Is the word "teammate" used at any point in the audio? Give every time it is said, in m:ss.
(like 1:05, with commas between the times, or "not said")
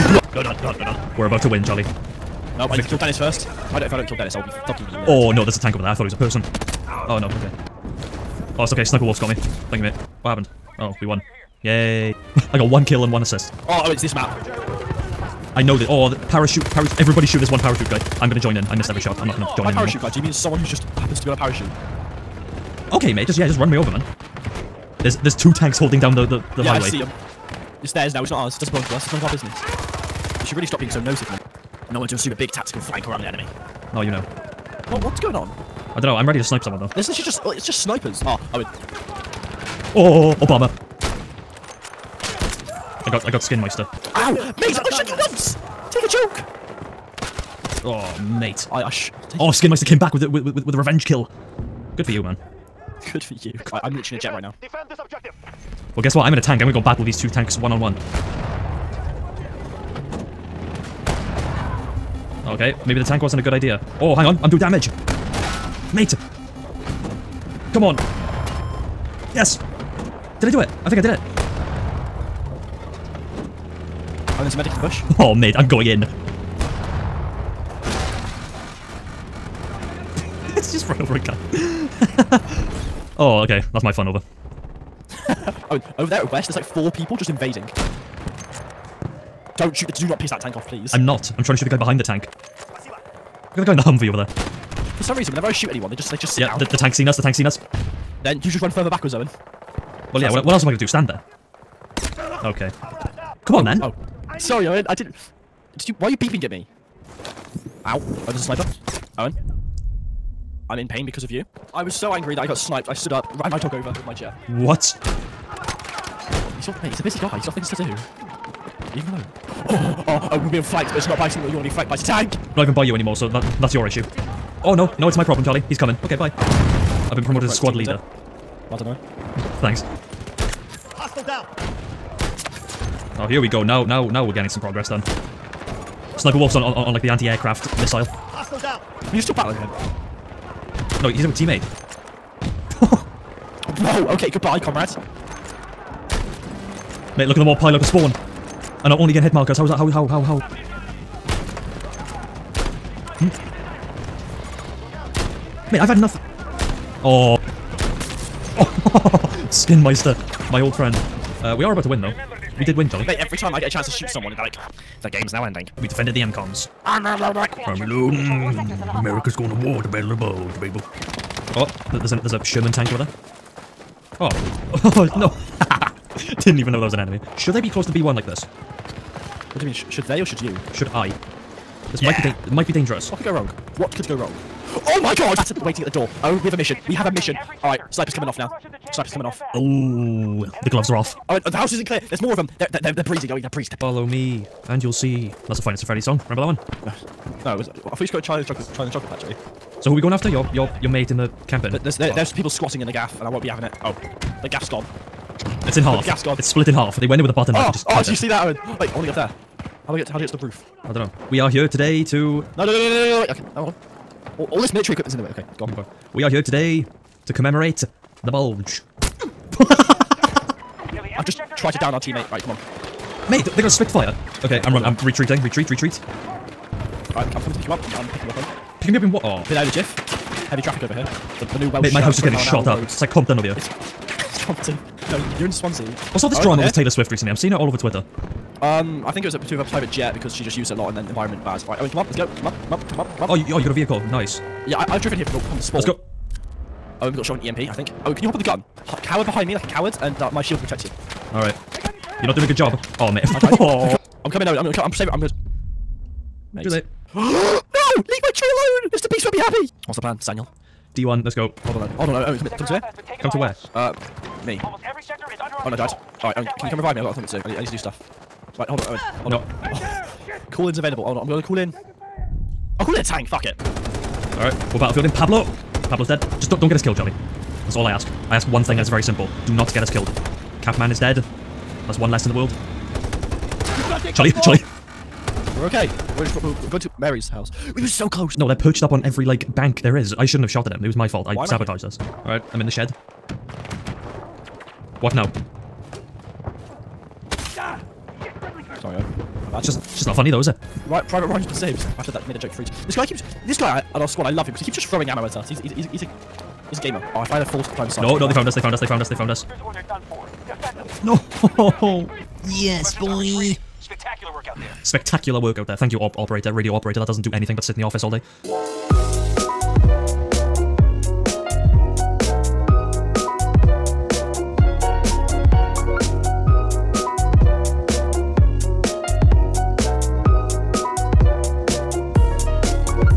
2:21, 3:41.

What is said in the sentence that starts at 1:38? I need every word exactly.
Then you just run further backwards, Owen.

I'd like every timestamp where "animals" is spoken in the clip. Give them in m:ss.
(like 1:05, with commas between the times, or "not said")
not said.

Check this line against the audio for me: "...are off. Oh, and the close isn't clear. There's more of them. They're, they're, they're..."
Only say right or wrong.
wrong.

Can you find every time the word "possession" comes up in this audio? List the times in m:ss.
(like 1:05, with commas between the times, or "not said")
not said.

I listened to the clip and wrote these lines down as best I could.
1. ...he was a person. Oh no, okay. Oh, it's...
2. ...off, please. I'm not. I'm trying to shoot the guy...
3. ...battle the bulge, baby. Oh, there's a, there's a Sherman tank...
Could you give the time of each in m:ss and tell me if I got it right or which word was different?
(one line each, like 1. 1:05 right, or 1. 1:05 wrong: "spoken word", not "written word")
1. 0:06 right
2. 1:30 right
3. 2:49 right.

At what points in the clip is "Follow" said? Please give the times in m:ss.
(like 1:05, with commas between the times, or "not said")
3:13.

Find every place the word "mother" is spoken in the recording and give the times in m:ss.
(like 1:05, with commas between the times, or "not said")
not said.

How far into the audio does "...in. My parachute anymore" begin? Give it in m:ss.
0:19.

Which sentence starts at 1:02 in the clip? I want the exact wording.
Okay, maybe the tank wasn't a good idea.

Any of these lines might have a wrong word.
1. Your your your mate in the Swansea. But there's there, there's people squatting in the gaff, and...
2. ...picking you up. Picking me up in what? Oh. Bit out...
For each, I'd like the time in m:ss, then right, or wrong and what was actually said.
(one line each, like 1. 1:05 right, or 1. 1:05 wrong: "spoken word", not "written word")
1. 3:20 wrong: "Camping", not "Swansea"
2. 3:48 right.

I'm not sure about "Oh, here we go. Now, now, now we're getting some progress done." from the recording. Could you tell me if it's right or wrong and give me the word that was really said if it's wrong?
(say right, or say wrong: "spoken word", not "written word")
right.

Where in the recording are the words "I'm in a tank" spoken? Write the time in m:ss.
0:56.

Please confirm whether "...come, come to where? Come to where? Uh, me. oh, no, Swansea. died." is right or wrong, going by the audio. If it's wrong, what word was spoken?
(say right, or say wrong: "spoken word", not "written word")
wrong: "Dad", not "Swansea".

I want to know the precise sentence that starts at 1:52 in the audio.
I stood up, ran my dog over with my chair.